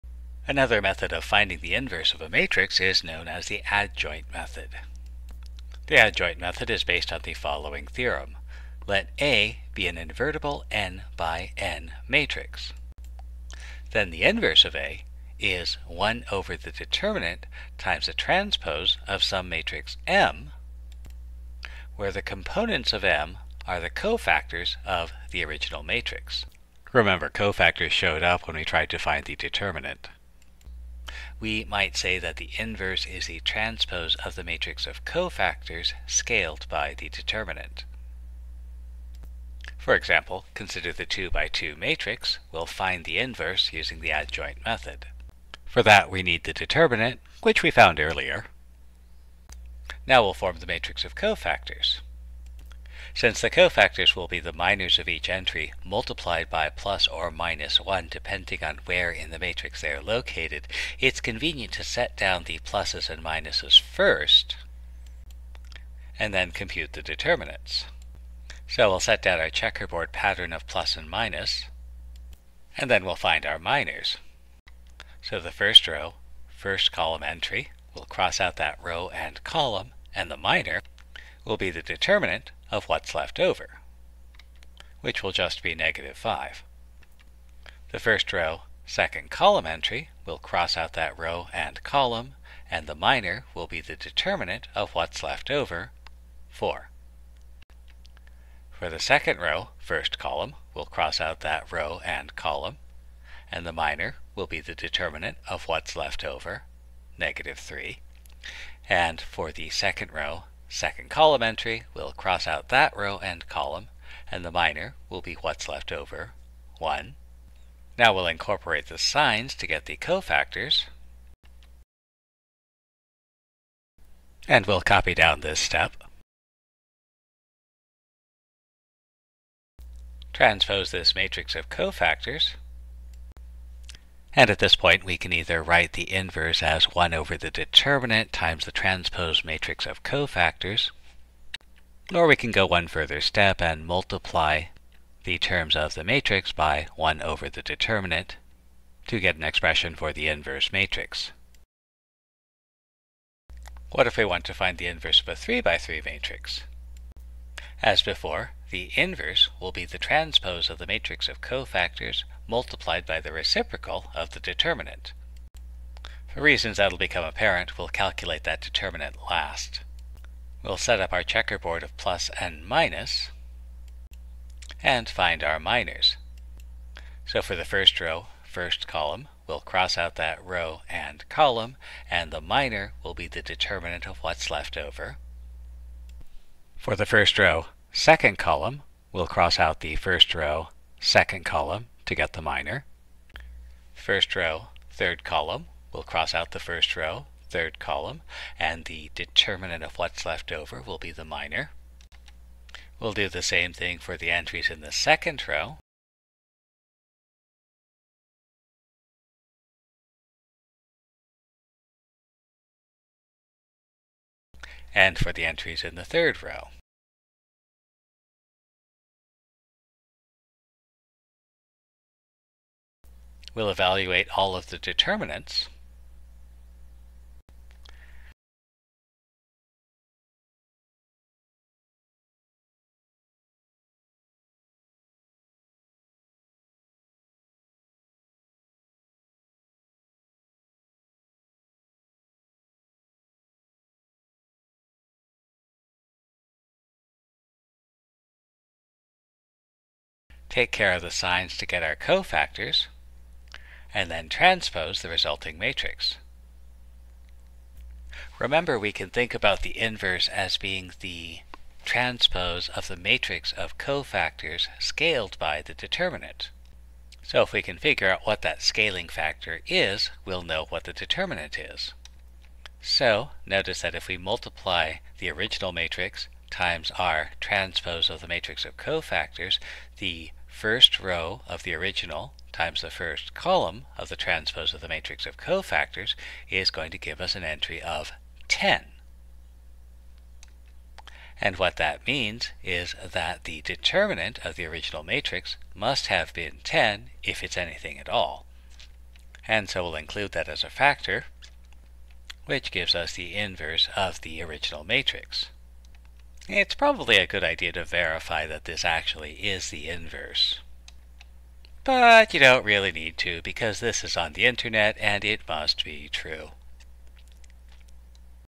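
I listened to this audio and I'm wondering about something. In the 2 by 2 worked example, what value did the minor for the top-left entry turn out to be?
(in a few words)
-5.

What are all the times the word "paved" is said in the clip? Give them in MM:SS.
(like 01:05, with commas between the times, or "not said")
not said.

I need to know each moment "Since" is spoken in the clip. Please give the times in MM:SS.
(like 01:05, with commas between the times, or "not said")
00:53.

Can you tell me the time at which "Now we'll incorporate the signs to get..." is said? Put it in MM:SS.
01:57.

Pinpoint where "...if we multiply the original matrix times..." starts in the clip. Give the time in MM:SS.
04:33.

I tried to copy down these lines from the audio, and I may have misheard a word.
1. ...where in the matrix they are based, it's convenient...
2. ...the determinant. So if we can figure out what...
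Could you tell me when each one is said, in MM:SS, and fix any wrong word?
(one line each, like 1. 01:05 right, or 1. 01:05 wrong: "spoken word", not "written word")
1. 00:58 wrong: "located", not "based"
2. 04:25 right.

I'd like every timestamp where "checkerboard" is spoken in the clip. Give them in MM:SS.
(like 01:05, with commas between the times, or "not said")
01:09, 02:51.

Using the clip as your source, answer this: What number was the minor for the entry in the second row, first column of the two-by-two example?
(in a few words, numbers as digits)
-3.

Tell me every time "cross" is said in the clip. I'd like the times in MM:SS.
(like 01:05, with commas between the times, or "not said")
01:18, 01:30, 01:40, 01:52, 02:59, 03:09, 03:16.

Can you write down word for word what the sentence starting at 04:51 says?
And what that means is that the determinant of the original matrix must have been 10 if it's anything at all.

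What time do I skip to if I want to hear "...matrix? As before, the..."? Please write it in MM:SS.
02:36.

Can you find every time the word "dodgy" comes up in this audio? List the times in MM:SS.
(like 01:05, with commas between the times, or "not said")
not said.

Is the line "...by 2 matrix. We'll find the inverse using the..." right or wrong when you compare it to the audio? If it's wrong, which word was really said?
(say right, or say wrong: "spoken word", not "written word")
right.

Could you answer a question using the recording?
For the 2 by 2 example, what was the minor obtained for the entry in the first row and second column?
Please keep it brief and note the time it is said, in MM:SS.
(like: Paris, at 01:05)
4, at 01:36.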